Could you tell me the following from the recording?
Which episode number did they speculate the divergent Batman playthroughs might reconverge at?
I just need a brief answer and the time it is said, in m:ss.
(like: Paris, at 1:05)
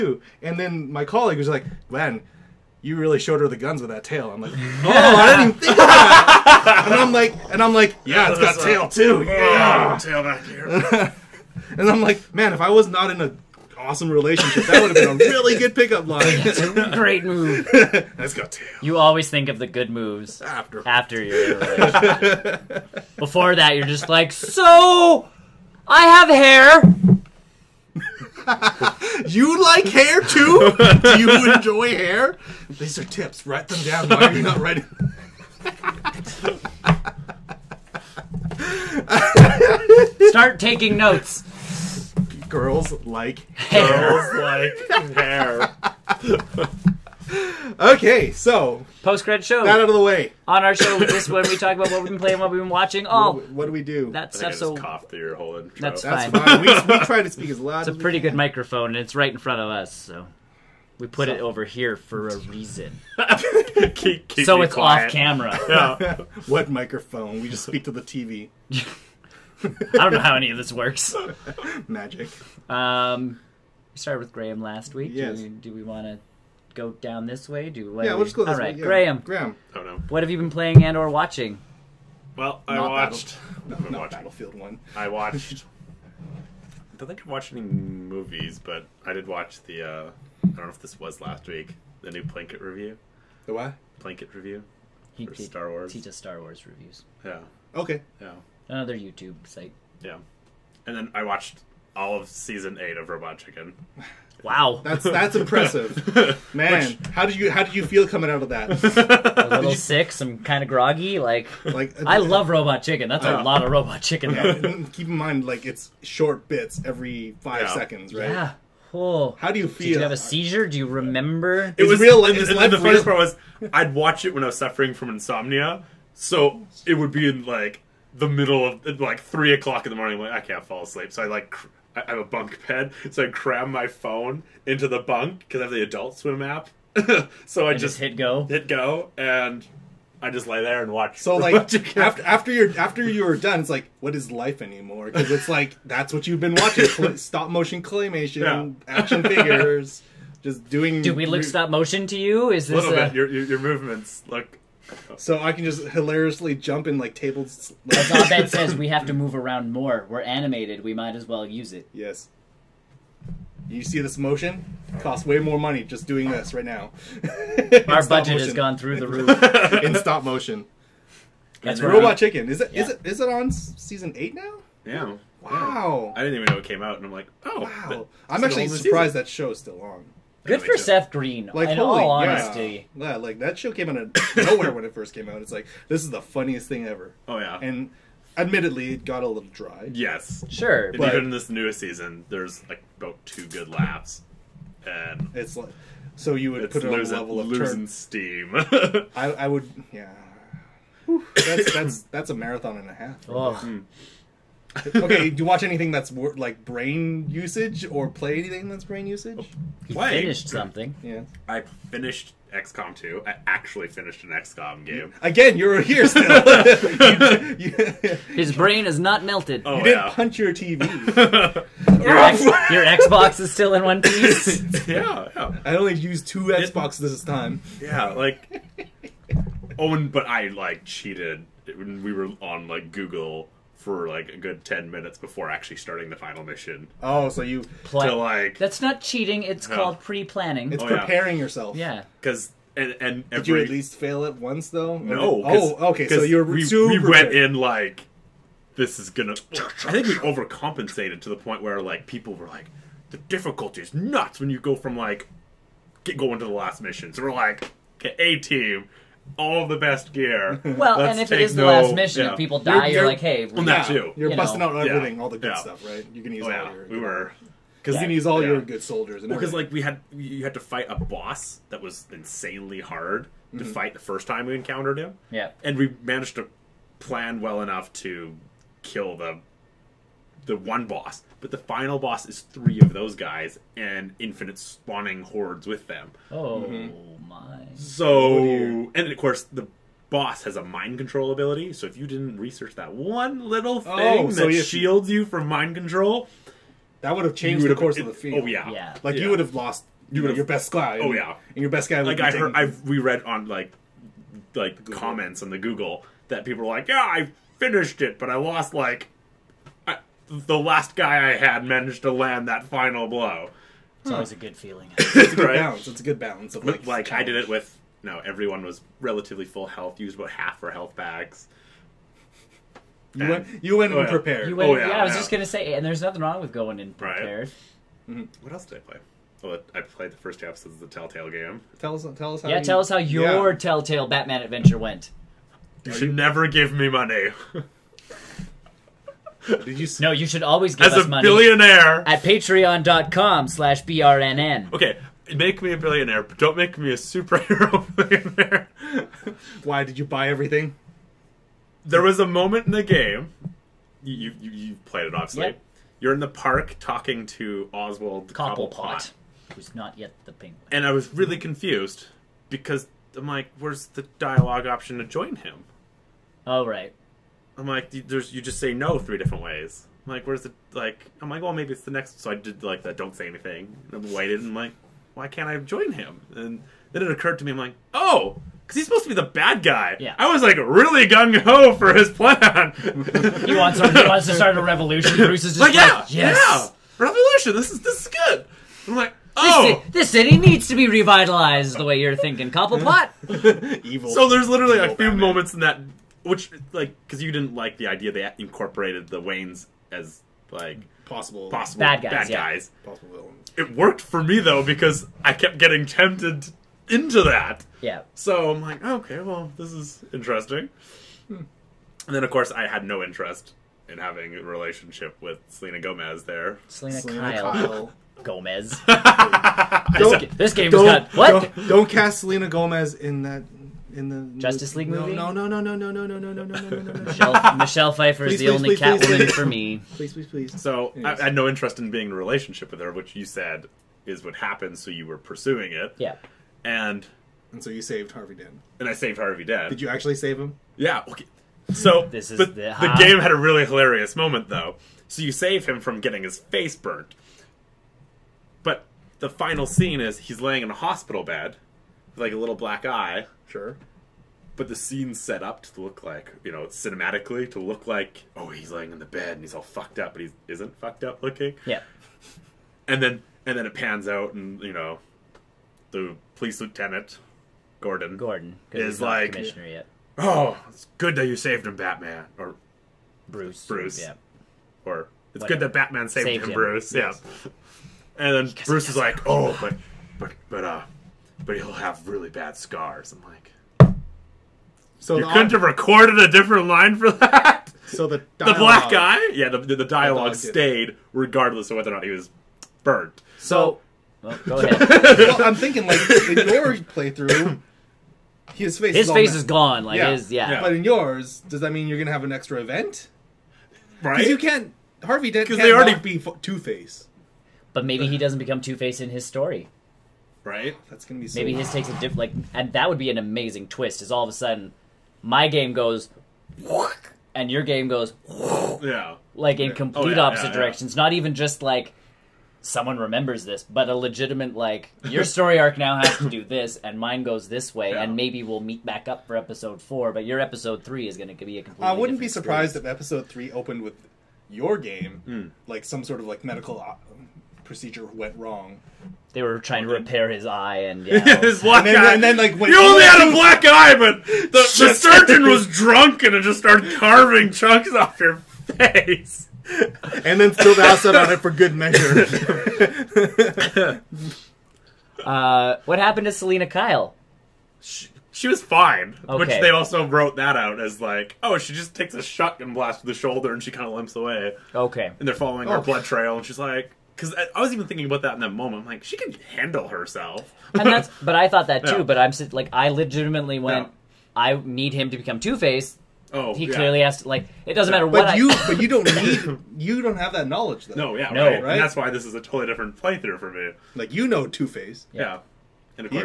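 4, at 8:49.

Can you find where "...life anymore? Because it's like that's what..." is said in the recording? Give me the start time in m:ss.
2:24.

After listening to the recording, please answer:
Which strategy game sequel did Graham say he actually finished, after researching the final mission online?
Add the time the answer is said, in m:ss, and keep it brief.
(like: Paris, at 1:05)
XCOM 2, at 3:32.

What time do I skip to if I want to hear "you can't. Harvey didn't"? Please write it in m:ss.
8:24.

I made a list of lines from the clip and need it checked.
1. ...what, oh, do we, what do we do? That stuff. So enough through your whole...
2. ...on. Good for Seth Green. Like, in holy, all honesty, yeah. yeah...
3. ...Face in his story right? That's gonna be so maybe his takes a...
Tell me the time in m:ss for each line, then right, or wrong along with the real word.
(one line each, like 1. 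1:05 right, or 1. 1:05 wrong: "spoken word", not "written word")
1. 0:53 wrong: "cough", not "enough"
2. 2:59 right
3. 8:28 right.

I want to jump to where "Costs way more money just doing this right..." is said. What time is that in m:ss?
2:44.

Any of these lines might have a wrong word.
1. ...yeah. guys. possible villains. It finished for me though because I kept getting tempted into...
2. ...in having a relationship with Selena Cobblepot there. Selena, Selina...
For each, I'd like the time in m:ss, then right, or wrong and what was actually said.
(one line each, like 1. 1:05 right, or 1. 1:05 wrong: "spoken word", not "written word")
1. 6:42 wrong: "worked", not "finished"
2. 6:53 wrong: "Gomez", not "Cobblepot".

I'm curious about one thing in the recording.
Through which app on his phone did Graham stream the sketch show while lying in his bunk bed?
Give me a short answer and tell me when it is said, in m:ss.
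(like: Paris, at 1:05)
Adult Swim app, at 2:15.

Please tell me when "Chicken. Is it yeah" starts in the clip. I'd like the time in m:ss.
2:52.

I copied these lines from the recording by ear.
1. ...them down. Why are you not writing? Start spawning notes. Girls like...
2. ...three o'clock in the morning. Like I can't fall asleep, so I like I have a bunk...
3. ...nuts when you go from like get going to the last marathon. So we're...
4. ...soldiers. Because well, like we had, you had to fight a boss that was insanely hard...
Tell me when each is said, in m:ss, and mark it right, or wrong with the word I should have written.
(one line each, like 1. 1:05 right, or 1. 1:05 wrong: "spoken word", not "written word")
1. 0:33 wrong: "taking", not "spawning"
2. 2:09 right
3. 4:13 wrong: "mission", not "marathon"
4. 4:28 right.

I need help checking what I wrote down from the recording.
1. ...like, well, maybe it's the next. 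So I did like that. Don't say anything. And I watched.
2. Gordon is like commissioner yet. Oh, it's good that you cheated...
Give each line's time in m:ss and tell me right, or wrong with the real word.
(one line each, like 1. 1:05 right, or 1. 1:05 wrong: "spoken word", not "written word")
1. 6:11 wrong: "waited", not "watched"
2. 7:48 wrong: "saved", not "cheated".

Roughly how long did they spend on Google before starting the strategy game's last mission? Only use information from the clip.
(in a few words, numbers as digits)
10 minutes.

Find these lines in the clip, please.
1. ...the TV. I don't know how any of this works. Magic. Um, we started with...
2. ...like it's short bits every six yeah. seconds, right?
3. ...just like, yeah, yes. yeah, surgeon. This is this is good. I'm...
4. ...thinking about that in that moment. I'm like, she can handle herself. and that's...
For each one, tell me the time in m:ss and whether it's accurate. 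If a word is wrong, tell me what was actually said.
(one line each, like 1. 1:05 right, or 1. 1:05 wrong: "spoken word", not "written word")
1. 1:07 right
2. 1:55 wrong: "five", not "six"
3. 6:25 wrong: "revolution", not "surgeon"
4. 9:27 right.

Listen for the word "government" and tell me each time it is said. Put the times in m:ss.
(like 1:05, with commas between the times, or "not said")
not said.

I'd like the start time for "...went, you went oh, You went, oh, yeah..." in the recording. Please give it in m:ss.
5:23.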